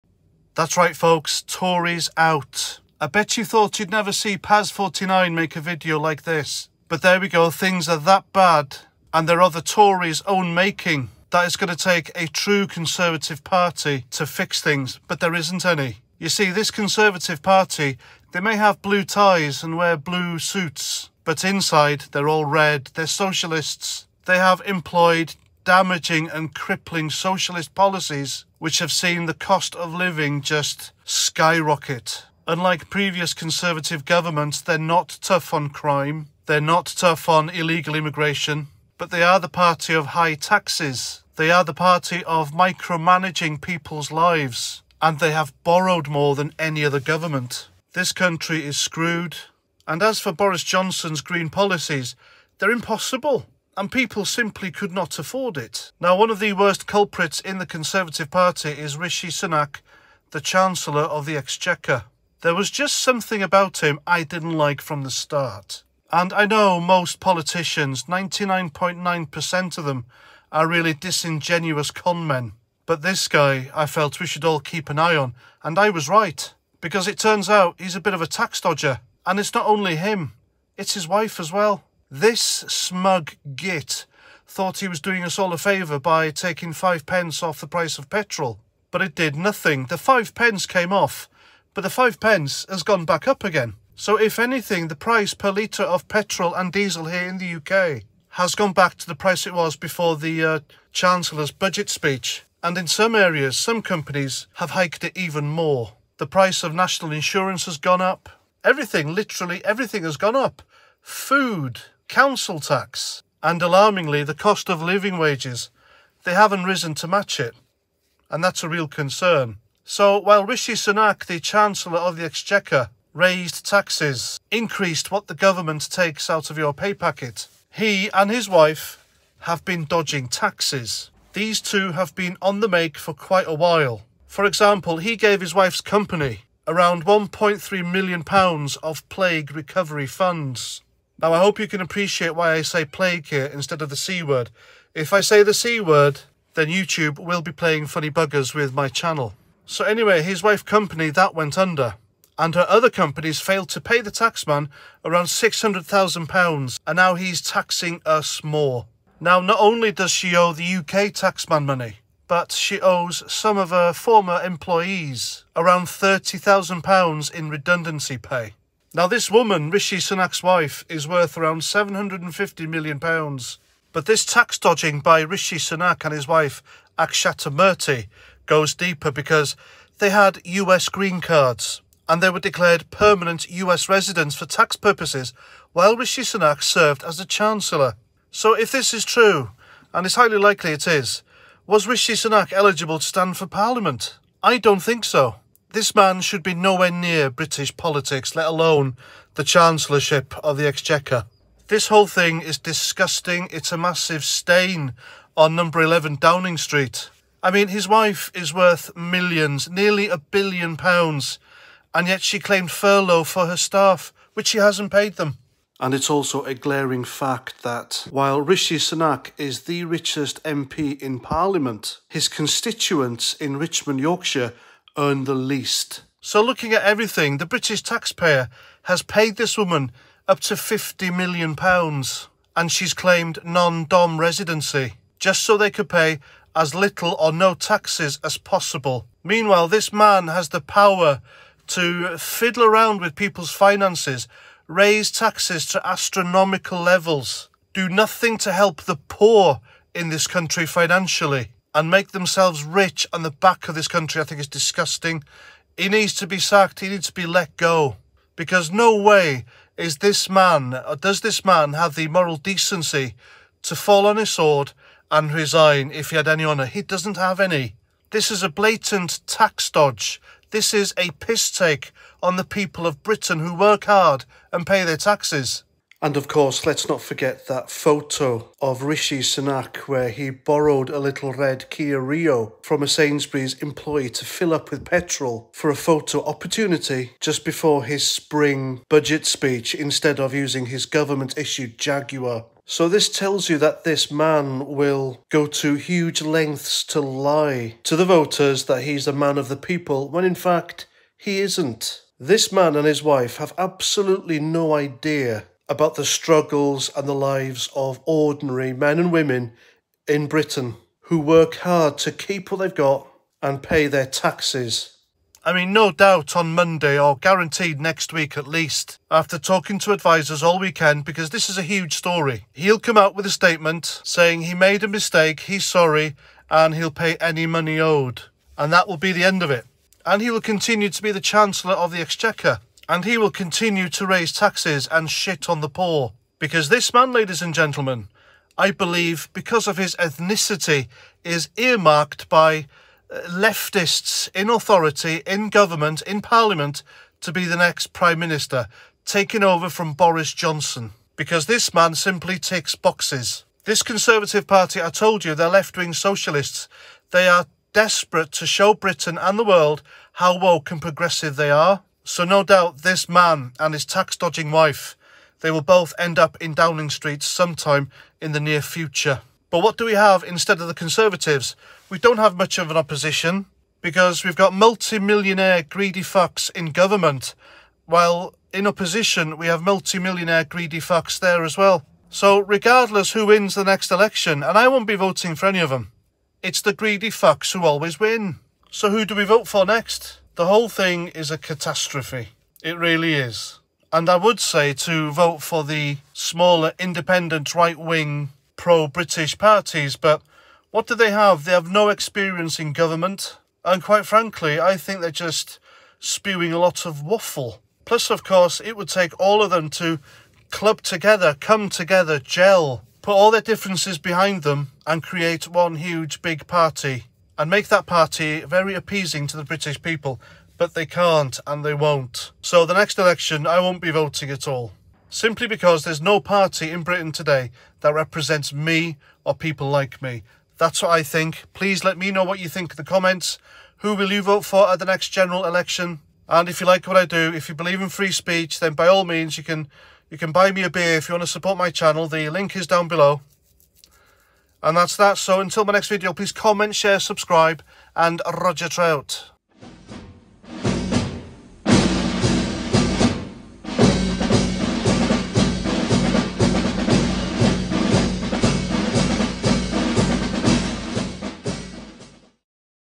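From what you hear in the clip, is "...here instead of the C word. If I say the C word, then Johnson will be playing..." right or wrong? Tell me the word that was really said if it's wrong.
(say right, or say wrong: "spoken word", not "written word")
wrong: "YouTube", not "Johnson".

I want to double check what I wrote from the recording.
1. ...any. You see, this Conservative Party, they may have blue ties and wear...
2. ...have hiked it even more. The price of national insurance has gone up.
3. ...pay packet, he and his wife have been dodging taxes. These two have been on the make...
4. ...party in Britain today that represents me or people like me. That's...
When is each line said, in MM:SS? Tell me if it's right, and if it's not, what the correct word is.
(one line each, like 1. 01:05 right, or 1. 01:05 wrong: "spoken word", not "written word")
1. 00:15 right
2. 01:44 right
3. 02:06 right
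4. 07:06 right.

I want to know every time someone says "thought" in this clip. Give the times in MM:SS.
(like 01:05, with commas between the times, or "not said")
00:03, 01:24.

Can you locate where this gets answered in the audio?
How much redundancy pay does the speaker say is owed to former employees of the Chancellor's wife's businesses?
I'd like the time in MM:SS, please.
02:45.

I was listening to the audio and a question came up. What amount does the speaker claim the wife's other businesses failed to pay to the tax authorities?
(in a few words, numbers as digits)
£600,000.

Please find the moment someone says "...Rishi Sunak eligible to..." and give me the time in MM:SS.
03:11.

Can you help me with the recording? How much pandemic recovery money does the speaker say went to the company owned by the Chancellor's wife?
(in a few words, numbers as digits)
£1.3 million.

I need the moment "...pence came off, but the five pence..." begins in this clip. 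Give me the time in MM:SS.
01:30.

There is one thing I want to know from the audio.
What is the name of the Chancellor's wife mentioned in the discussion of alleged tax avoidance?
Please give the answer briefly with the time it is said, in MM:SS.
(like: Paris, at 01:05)
Akshata Murthy, at 02:56.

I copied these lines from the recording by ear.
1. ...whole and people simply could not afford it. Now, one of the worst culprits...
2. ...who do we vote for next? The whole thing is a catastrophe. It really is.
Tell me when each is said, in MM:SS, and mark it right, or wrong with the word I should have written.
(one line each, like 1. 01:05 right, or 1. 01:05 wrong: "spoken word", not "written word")
1. 00:52 wrong: "impossible", not "whole"
2. 06:28 right.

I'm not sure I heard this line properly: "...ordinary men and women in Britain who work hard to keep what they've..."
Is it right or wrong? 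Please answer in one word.
right.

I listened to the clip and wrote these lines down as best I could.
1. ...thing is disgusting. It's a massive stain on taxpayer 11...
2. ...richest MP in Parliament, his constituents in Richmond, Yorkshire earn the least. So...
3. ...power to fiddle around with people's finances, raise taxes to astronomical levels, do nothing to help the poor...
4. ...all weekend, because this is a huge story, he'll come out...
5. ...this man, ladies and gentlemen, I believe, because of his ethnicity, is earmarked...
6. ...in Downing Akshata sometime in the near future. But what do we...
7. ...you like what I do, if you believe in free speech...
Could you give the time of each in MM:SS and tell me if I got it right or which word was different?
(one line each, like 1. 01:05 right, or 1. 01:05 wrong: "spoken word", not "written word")
1. 03:22 wrong: "number", not "taxpayer"
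2. 03:39 right
3. 04:00 right
4. 05:20 right
5. 05:36 right
6. 06:06 wrong: "Street", not "Akshata"
7. 07:16 right.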